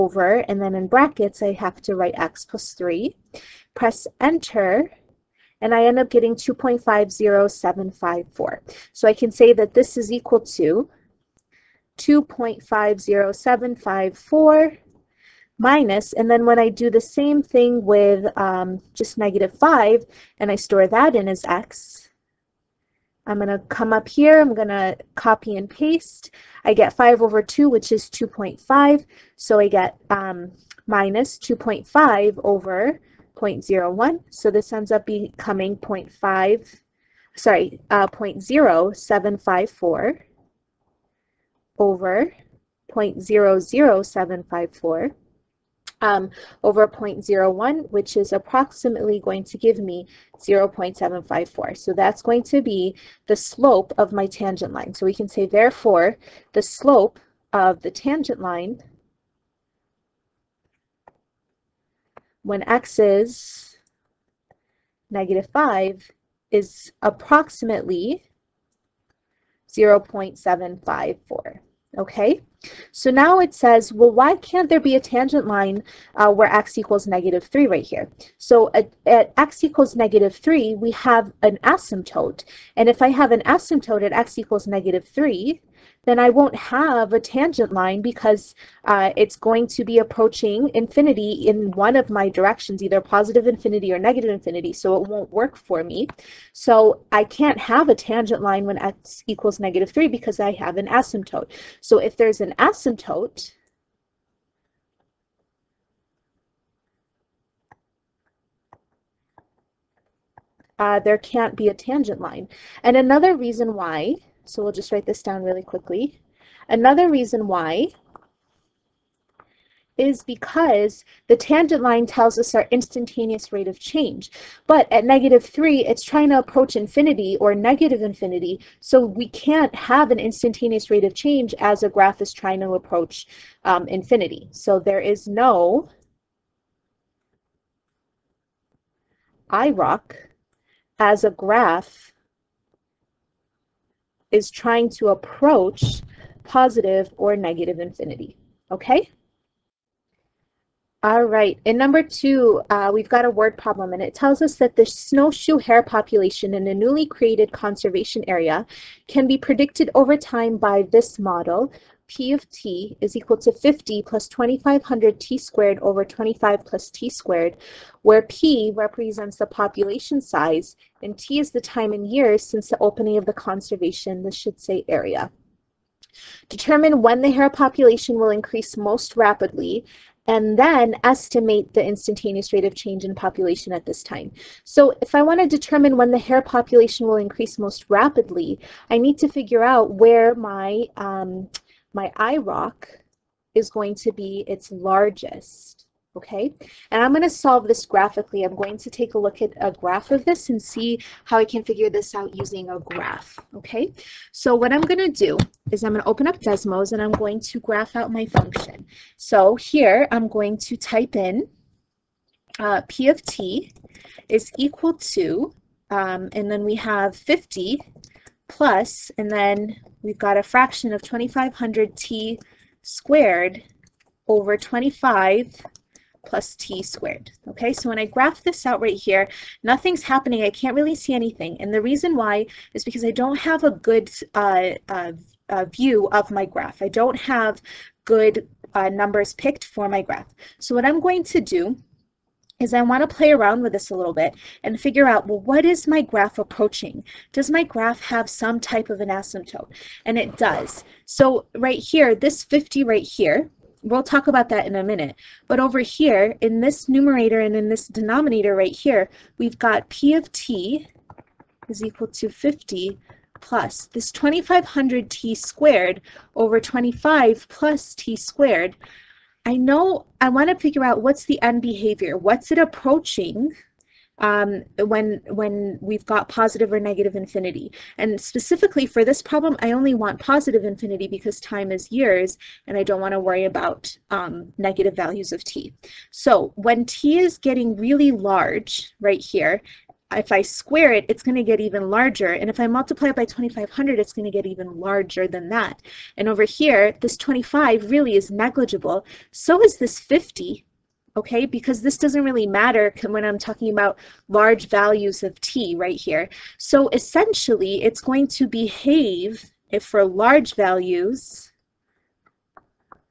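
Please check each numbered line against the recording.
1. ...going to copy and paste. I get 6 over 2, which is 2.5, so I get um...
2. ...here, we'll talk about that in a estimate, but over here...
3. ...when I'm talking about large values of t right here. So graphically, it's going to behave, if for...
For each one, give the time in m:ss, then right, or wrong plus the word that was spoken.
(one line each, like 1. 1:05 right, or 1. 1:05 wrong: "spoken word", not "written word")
1. 0:24 wrong: "5", not "6"
2. 4:13 wrong: "minute", not "estimate"
3. 5:03 wrong: "essentially", not "graphically".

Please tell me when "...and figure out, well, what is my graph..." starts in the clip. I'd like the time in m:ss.
4:04.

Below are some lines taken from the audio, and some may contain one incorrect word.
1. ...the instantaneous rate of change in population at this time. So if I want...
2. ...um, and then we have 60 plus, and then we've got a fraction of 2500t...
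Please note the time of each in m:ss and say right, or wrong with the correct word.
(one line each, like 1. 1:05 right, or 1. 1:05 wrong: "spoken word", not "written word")
1. 3:01 right
2. 3:35 wrong: "50", not "60".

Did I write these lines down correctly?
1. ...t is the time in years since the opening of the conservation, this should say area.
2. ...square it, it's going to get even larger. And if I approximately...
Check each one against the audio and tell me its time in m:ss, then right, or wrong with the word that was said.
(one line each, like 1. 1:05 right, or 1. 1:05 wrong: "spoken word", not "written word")
1. 2:51 right
2. 4:50 wrong: "multiply", not "approximately".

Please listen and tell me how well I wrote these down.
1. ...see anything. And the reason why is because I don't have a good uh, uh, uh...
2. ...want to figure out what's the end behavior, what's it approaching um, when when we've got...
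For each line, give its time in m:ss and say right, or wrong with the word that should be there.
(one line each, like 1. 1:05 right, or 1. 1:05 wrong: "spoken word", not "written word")
1. 3:50 right
2. 4:30 right.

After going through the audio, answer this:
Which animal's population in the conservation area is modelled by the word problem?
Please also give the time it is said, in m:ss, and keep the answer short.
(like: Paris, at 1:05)
Snowshoe hare, at 2:34.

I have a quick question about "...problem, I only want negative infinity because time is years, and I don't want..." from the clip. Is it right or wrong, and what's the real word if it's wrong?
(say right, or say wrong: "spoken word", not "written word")
wrong: "positive", not "negative".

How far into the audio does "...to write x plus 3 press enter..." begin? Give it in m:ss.
0:01.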